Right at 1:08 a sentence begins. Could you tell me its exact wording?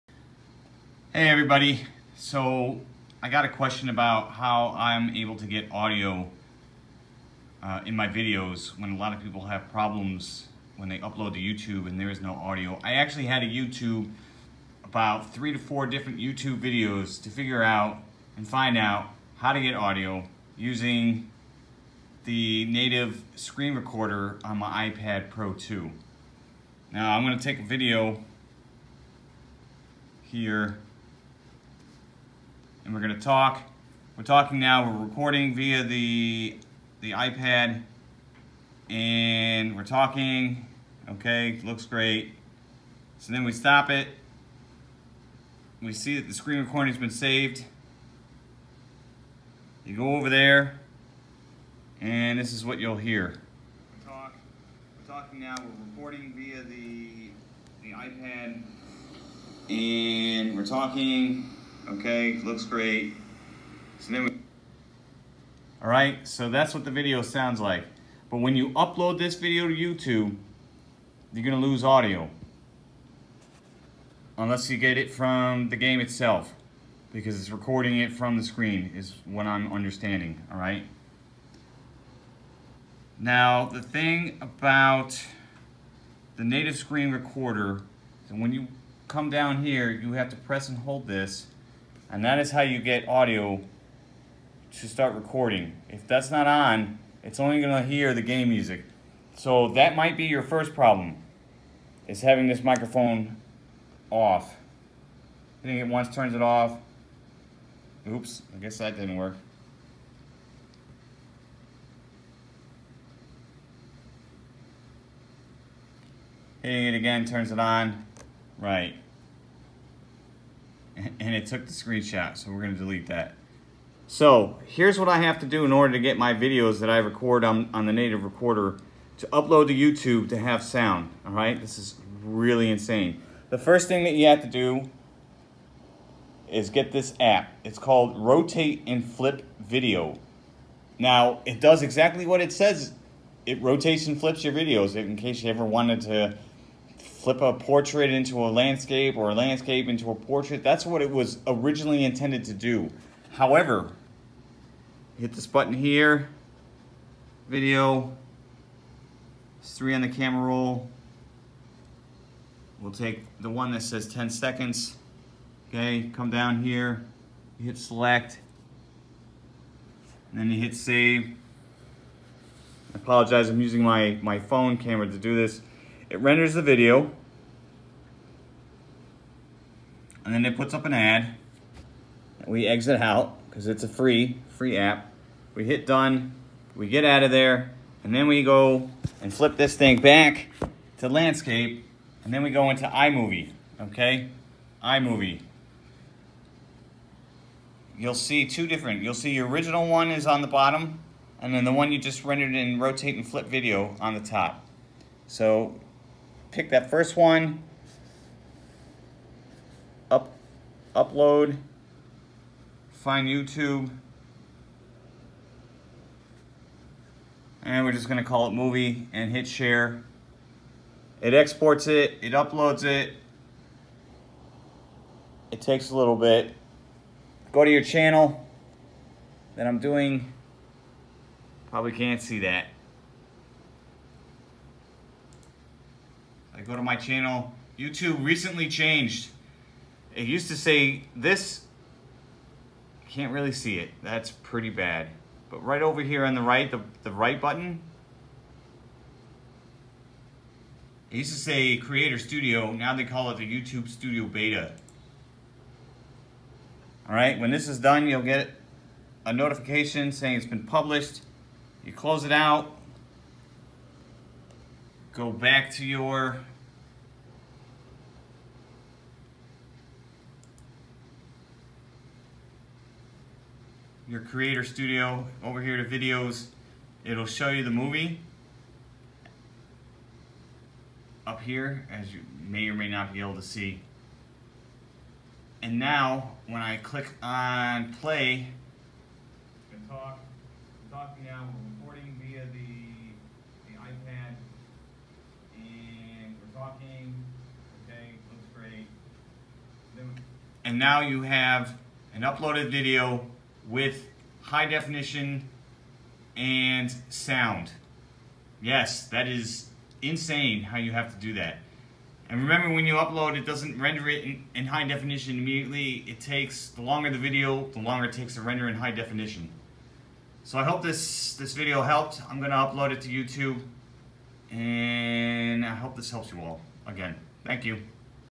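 But when you upload this video to YouTube, you're gonna lose audio.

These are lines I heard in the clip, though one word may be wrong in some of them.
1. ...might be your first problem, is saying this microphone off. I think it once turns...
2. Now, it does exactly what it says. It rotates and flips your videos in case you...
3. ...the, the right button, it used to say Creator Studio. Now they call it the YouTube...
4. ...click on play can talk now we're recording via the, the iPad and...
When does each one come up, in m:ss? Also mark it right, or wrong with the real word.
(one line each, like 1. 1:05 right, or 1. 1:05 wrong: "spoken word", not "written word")
1. 1:39 wrong: "having", not "saying"
2. 2:20 right
3. 4:06 right
4. 4:46 right.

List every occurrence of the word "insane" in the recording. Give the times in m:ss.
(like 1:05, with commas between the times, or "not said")
2:12, 5:10.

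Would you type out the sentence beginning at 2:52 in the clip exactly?
I apologize, I'm using my, my phone camera to do this it renders the video, and then it puts up an ad.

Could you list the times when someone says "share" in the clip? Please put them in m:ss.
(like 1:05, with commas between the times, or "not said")
3:39.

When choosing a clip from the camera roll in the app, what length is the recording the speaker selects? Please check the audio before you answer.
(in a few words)
10 seconds.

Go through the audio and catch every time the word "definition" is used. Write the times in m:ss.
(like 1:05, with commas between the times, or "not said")
5:04, 5:14, 5:18.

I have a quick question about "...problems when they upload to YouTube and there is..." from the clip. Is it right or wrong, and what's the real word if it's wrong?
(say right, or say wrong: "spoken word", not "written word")
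right.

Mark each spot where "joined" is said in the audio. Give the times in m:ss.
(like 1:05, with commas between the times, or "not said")
not said.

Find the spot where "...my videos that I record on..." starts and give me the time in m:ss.
2:06.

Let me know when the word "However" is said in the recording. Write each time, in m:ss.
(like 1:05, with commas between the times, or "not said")
2:33.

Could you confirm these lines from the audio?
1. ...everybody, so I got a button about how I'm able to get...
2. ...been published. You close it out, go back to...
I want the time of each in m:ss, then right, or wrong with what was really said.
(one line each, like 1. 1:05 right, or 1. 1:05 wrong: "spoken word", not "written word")
1. 0:01 wrong: "question", not "button"
2. 4:20 right.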